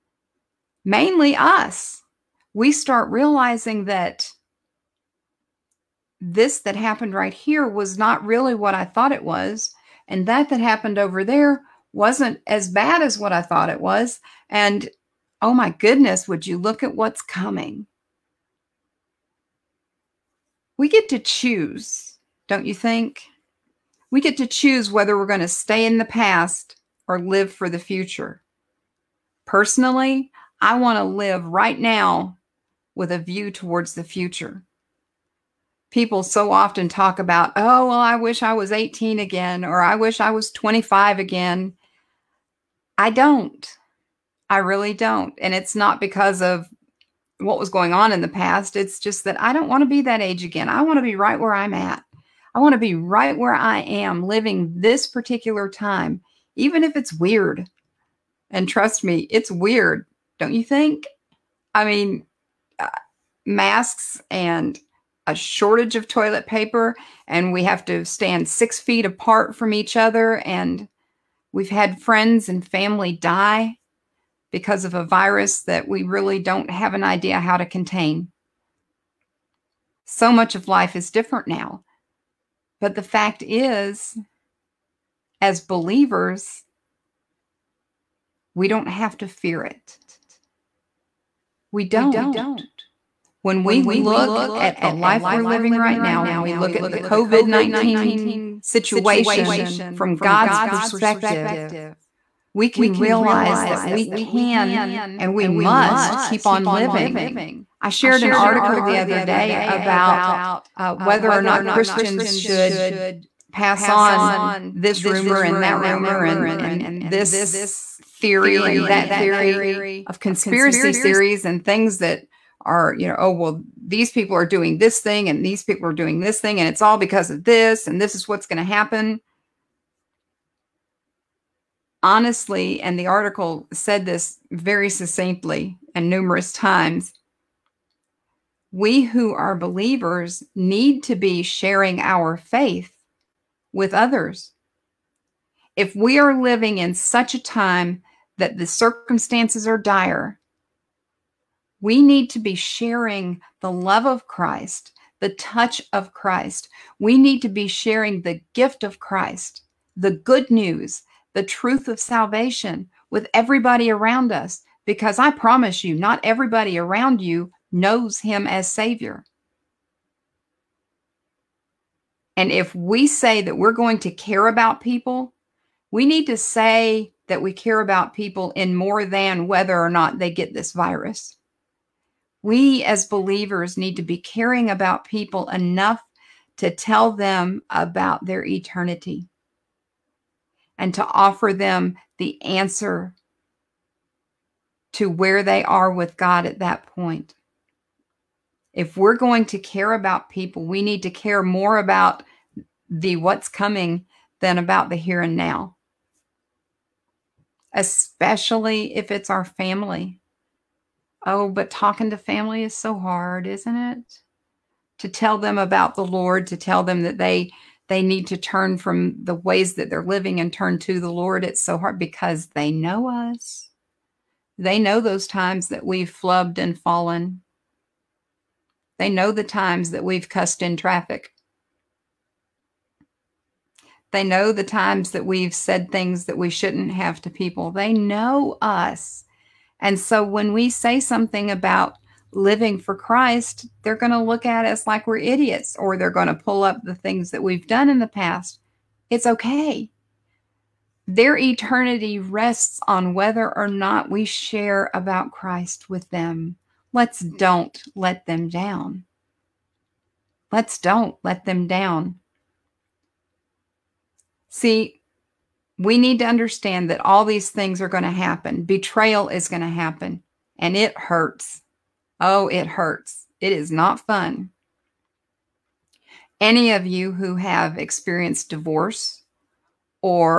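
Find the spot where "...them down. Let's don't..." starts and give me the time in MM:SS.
04:18.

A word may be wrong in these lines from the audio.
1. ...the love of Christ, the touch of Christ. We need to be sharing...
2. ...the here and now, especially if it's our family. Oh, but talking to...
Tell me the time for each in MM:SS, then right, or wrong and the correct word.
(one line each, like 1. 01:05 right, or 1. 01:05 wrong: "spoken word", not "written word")
1. 02:33 right
2. 03:24 right.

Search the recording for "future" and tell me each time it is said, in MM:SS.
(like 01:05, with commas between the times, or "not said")
00:27, 00:34.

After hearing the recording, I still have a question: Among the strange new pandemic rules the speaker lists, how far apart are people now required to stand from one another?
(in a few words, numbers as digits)
6 feet.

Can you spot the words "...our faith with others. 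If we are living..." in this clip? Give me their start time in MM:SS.
02:21.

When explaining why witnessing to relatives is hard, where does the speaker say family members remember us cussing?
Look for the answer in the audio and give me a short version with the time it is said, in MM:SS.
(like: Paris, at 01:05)
traffic, at 03:50.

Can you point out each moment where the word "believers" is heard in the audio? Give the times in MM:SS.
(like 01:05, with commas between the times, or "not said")
01:25, 02:19, 03:03.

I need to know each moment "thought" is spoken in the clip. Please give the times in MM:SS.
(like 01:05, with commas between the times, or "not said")
00:08, 00:13.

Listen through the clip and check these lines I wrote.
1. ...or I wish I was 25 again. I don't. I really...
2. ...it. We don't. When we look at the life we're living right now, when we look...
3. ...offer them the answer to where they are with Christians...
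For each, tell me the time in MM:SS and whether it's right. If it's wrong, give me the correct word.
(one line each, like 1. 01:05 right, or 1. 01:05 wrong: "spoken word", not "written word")
1. 00:39 right
2. 01:29 right
3. 03:11 wrong: "God", not "Christians".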